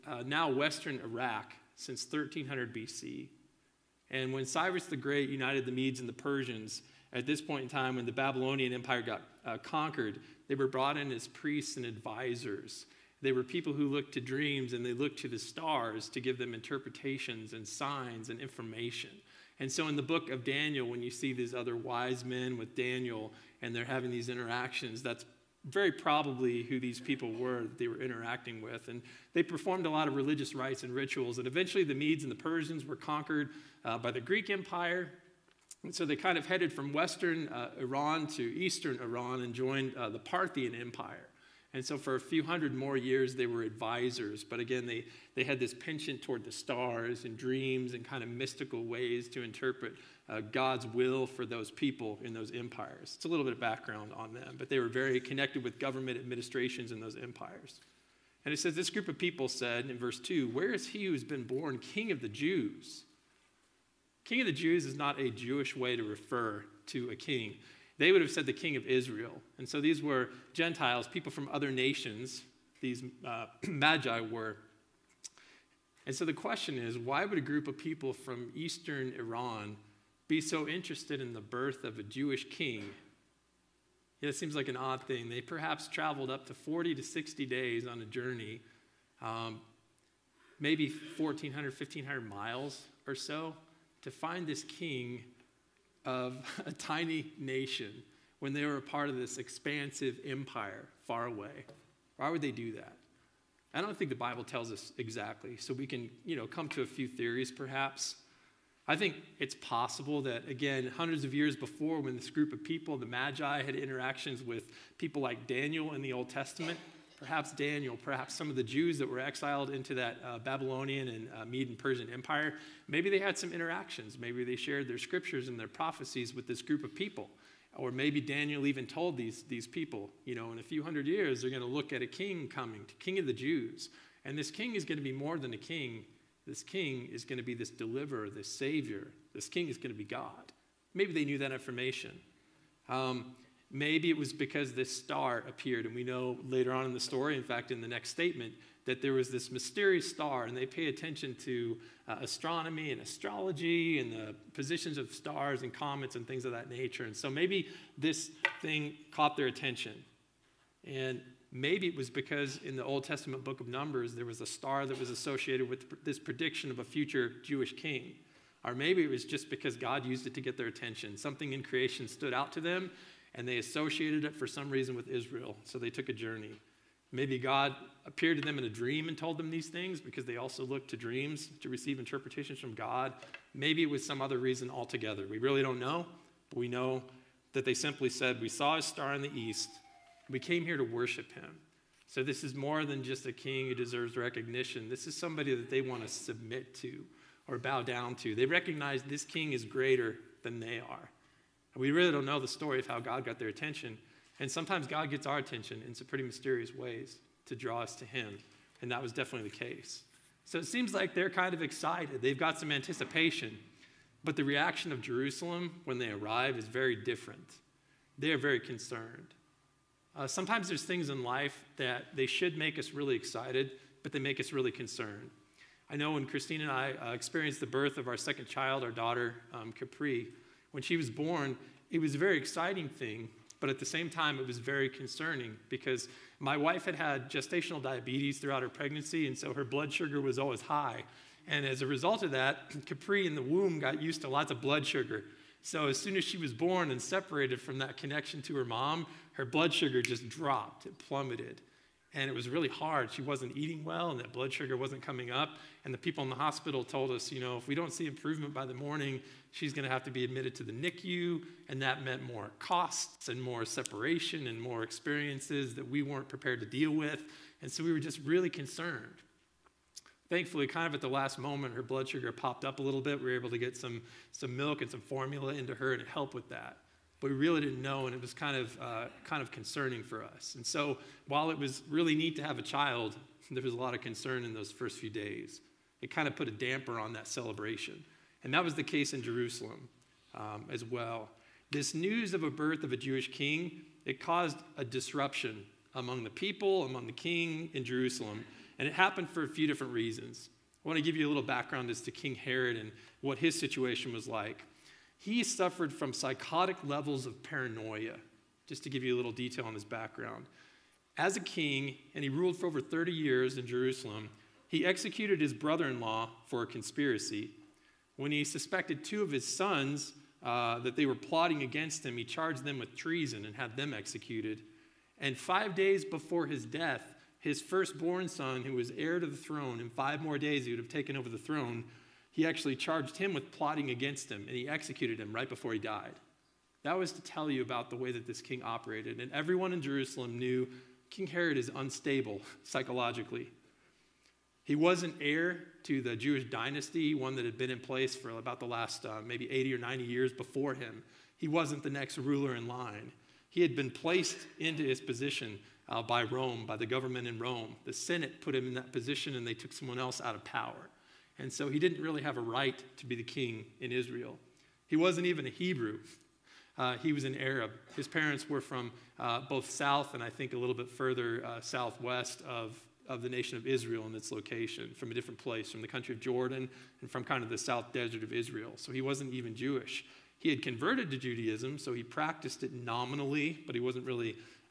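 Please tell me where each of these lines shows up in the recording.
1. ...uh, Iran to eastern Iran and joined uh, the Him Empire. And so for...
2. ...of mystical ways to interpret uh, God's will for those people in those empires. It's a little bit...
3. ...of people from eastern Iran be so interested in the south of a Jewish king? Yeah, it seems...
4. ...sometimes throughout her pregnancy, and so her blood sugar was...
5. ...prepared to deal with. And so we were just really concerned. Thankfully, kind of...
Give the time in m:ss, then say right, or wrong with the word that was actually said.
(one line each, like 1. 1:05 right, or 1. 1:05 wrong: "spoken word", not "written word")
1. 0:37 wrong: "Parthian", not "Him"
2. 0:48 right
3. 1:17 wrong: "birth", not "south"
4. 3:57 wrong: "diabetes", not "sometimes"
5. 4:26 right.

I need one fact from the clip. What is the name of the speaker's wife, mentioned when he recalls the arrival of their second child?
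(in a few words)
Christine.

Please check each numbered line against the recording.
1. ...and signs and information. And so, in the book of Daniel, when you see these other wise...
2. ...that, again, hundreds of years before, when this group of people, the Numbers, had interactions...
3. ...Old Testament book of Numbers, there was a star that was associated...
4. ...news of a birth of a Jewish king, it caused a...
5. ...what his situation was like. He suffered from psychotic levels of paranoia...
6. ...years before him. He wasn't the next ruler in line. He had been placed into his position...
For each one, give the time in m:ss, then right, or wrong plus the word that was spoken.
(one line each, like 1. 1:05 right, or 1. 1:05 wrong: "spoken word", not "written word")
1. 0:17 right
2. 1:50 wrong: "Magi", not "Numbers"
3. 2:42 right
4. 4:51 right
5. 5:03 right
6. 5:50 right.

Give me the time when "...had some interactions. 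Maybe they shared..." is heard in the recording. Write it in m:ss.
2:03.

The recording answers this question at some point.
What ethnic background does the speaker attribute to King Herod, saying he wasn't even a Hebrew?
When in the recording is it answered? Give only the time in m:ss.
6:07.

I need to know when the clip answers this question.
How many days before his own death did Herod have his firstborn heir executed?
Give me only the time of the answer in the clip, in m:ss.
5:25.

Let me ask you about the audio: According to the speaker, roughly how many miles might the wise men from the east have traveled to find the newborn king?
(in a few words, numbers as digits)
1,400 to 1,500 miles.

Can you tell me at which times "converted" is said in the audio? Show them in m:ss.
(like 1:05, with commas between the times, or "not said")
6:20.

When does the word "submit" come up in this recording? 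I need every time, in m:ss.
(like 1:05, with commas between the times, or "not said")
3:16.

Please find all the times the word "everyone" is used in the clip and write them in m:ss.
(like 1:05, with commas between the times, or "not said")
5:39.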